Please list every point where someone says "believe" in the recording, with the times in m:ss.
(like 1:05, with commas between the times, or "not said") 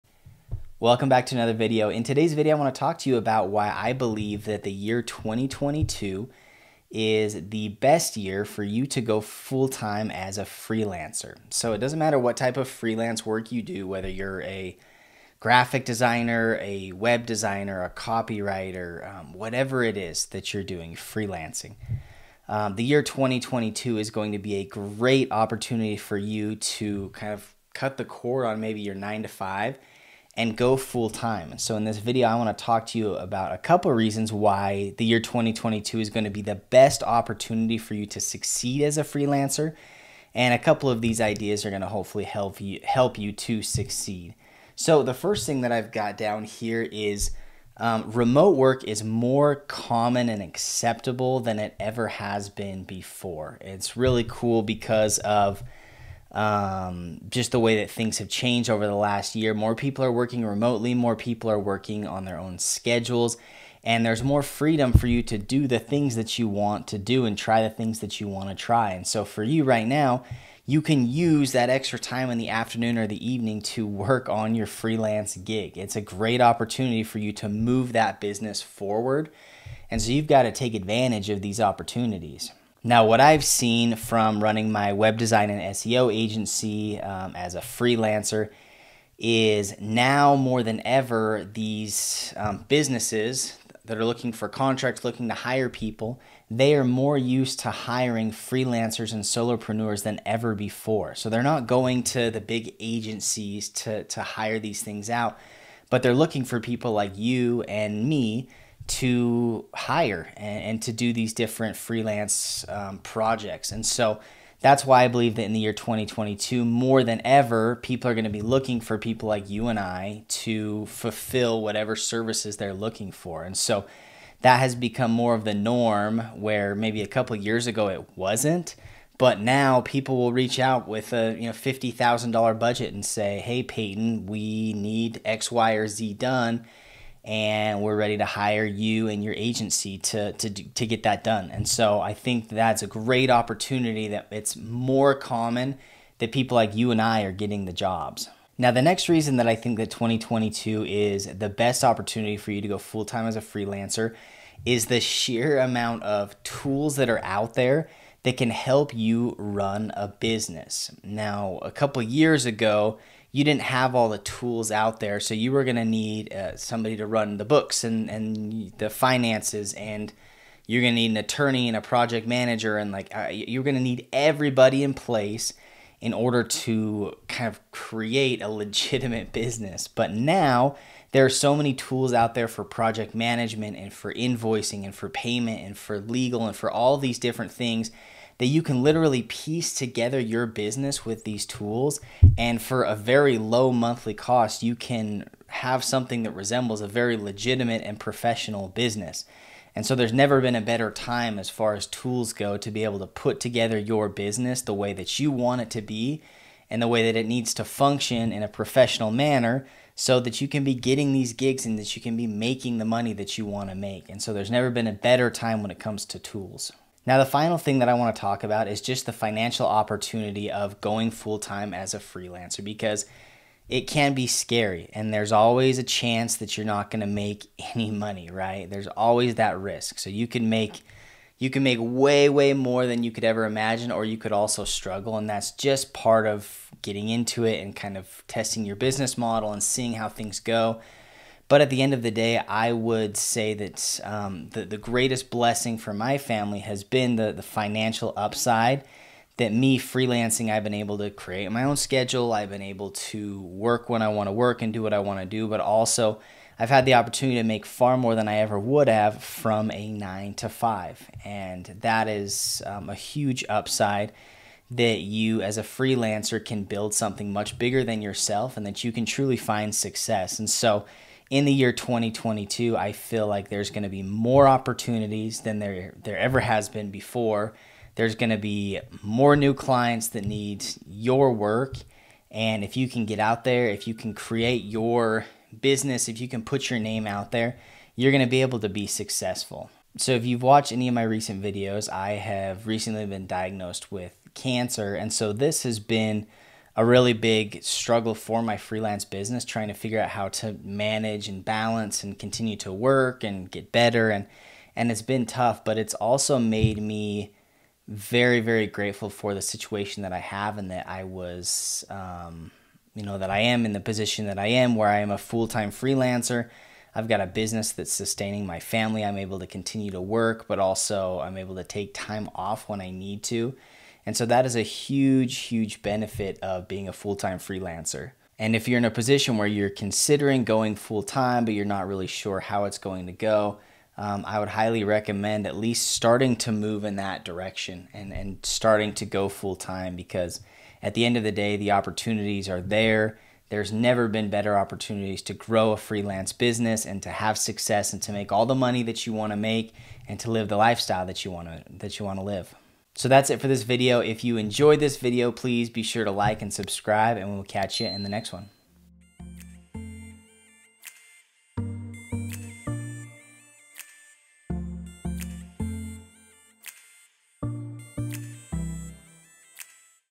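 0:03, 1:55.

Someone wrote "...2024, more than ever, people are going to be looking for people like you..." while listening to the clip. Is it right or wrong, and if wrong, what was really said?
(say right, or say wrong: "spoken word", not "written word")
wrong: "2022", not "2024".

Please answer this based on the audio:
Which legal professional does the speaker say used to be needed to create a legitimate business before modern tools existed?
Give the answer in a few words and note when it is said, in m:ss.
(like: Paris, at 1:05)
an attorney, at 2:51.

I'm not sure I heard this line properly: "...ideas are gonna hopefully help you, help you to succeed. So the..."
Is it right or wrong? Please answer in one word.
right.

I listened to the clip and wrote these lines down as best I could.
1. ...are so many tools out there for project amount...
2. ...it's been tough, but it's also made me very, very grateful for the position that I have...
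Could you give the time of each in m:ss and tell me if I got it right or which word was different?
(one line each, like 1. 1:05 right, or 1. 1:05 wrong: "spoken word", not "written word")
1. 3:01 wrong: "management", not "amount"
2. 5:04 wrong: "situation", not "position".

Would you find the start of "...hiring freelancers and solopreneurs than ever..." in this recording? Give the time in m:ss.
1:37.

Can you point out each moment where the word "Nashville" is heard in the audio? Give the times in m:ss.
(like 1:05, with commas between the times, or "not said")
not said.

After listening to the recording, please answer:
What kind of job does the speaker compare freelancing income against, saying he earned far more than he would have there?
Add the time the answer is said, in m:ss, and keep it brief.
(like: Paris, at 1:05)
a nine to five, at 4:19.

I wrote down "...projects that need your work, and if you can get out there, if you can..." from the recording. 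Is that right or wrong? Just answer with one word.
wrong.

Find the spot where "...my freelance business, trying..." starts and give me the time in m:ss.
4:58.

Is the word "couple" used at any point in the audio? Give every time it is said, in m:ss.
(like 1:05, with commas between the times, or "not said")
0:33, 0:40, 2:07, 2:41.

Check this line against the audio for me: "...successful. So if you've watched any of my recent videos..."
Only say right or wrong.
right.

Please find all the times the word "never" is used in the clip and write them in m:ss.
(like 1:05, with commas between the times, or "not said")
3:20, 3:34, 5:43.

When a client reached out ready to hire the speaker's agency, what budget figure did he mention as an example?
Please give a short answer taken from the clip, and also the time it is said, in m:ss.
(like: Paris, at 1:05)
$50000, at 2:11.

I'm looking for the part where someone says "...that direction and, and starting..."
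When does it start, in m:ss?
5:36.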